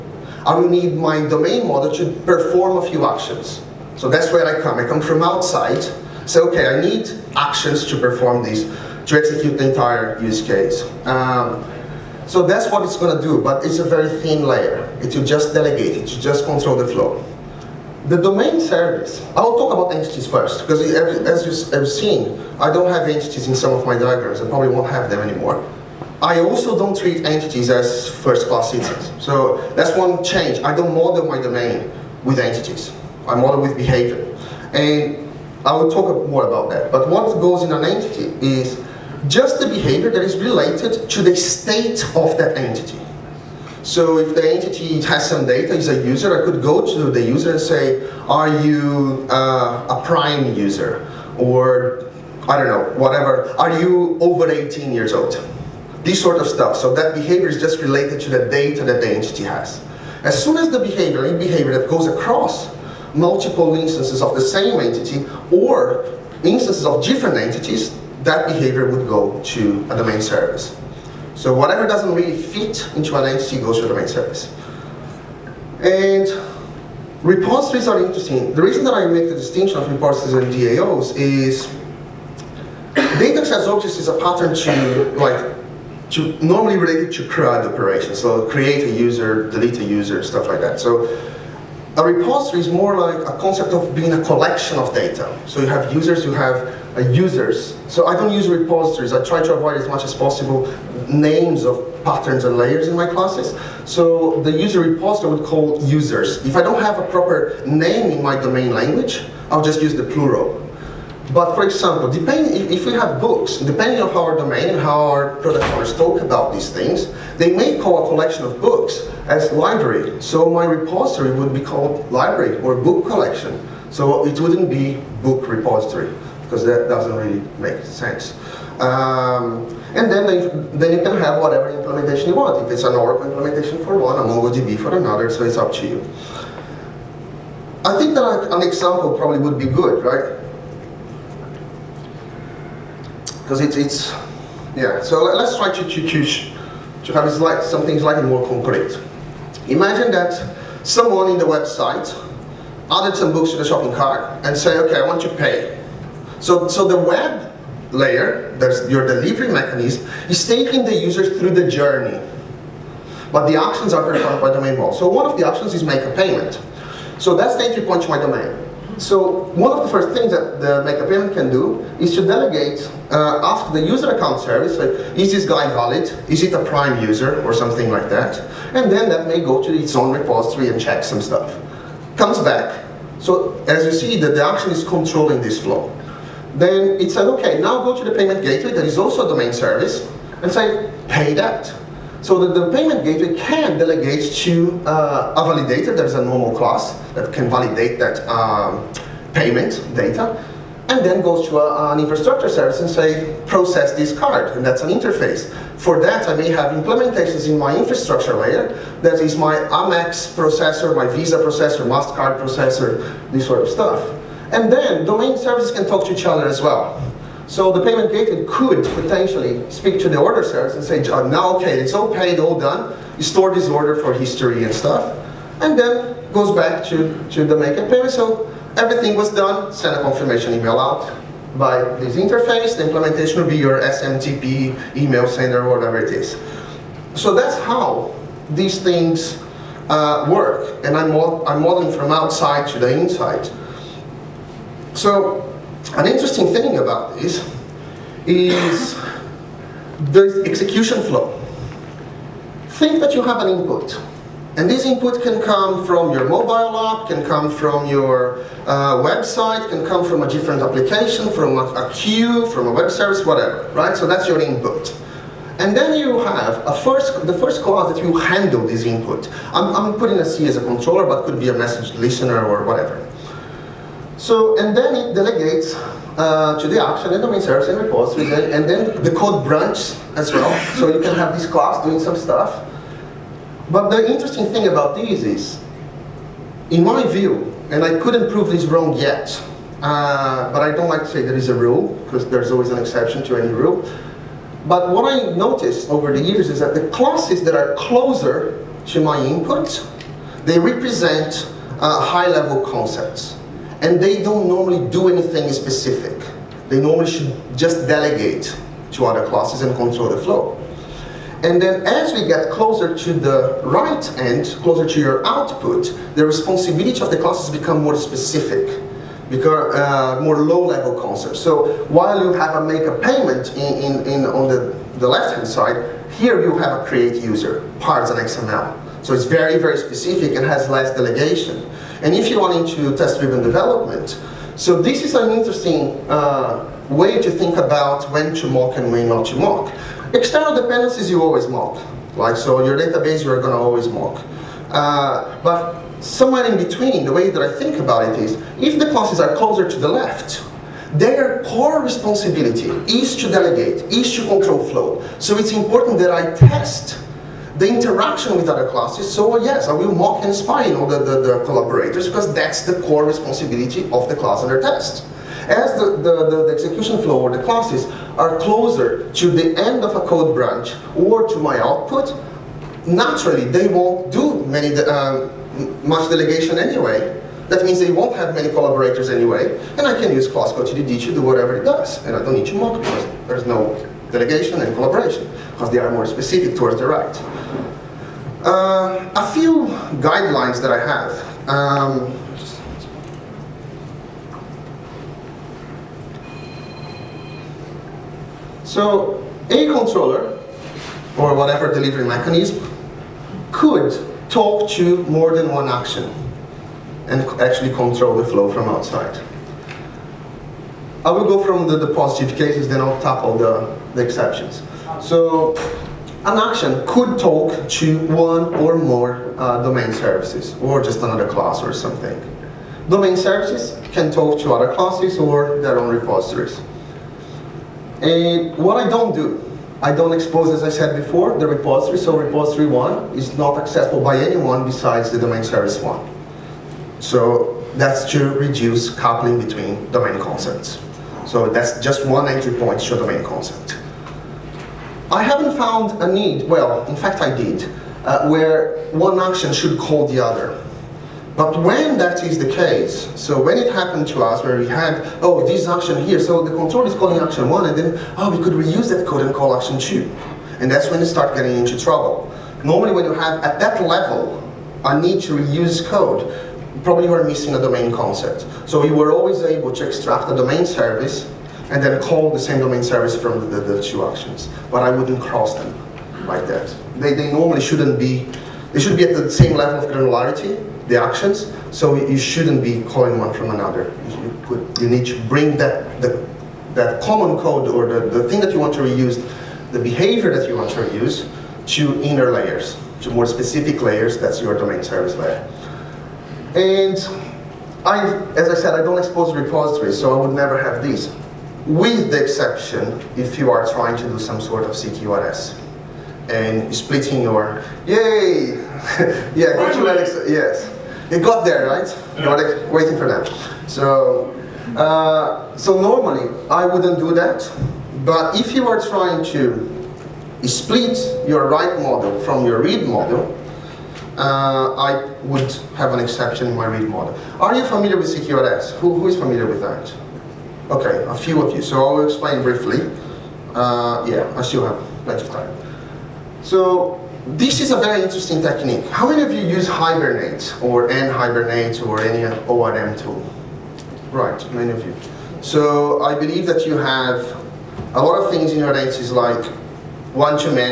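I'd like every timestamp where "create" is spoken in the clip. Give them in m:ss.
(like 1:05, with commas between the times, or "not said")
1:28, 5:26.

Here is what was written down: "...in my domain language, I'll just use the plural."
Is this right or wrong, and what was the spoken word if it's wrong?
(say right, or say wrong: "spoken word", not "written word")
right.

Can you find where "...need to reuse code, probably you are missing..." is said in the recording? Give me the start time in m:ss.
7:44.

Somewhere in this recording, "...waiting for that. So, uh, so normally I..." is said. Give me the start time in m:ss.
8:32.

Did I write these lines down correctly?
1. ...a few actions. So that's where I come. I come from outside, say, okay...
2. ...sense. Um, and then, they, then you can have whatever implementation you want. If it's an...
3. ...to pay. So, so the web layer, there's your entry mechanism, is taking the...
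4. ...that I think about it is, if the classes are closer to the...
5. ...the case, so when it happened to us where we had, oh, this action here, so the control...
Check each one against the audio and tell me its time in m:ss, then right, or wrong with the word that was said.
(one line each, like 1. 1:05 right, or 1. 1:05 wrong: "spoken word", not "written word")
1. 0:02 right
2. 2:07 right
3. 2:35 wrong: "delivery", not "entry"
4. 5:47 right
5. 7:32 right.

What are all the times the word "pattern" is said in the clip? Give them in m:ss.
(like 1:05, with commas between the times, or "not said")
1:24, 1:42.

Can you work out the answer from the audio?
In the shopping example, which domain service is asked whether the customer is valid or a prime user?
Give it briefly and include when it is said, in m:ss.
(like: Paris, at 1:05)
user account service, at 2:53.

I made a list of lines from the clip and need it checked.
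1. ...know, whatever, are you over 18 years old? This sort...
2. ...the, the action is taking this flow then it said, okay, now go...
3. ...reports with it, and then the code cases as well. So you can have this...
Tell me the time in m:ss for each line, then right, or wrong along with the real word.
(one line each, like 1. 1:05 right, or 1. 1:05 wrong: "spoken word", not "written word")
1. 0:52 right
2. 3:04 wrong: "controlling", not "taking"
3. 4:37 wrong: "branches", not "cases".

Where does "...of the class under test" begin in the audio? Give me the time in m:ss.
6:03.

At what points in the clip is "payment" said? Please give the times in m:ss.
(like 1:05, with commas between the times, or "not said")
2:46, 2:51, 3:08, 3:12, 3:19, 3:37, 3:47, 5:22.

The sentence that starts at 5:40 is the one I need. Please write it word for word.
External dependencies you always mock, like so your database you're going to always mock.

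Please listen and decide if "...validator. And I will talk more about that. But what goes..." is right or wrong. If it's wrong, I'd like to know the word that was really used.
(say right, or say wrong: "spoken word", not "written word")
wrong: "behavior", not "validator".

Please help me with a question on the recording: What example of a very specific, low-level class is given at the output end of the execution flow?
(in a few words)
parts and XML.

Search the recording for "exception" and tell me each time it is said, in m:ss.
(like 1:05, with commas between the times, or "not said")
4:52, 6:54, 8:22, 8:45.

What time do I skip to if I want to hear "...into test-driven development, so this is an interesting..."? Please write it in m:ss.
5:32.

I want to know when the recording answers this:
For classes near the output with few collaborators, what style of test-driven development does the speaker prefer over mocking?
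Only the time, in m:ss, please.
6:20.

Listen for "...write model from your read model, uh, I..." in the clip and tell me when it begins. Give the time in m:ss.
8:41.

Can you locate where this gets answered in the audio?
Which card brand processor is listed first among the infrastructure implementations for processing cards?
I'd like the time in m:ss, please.
3:29.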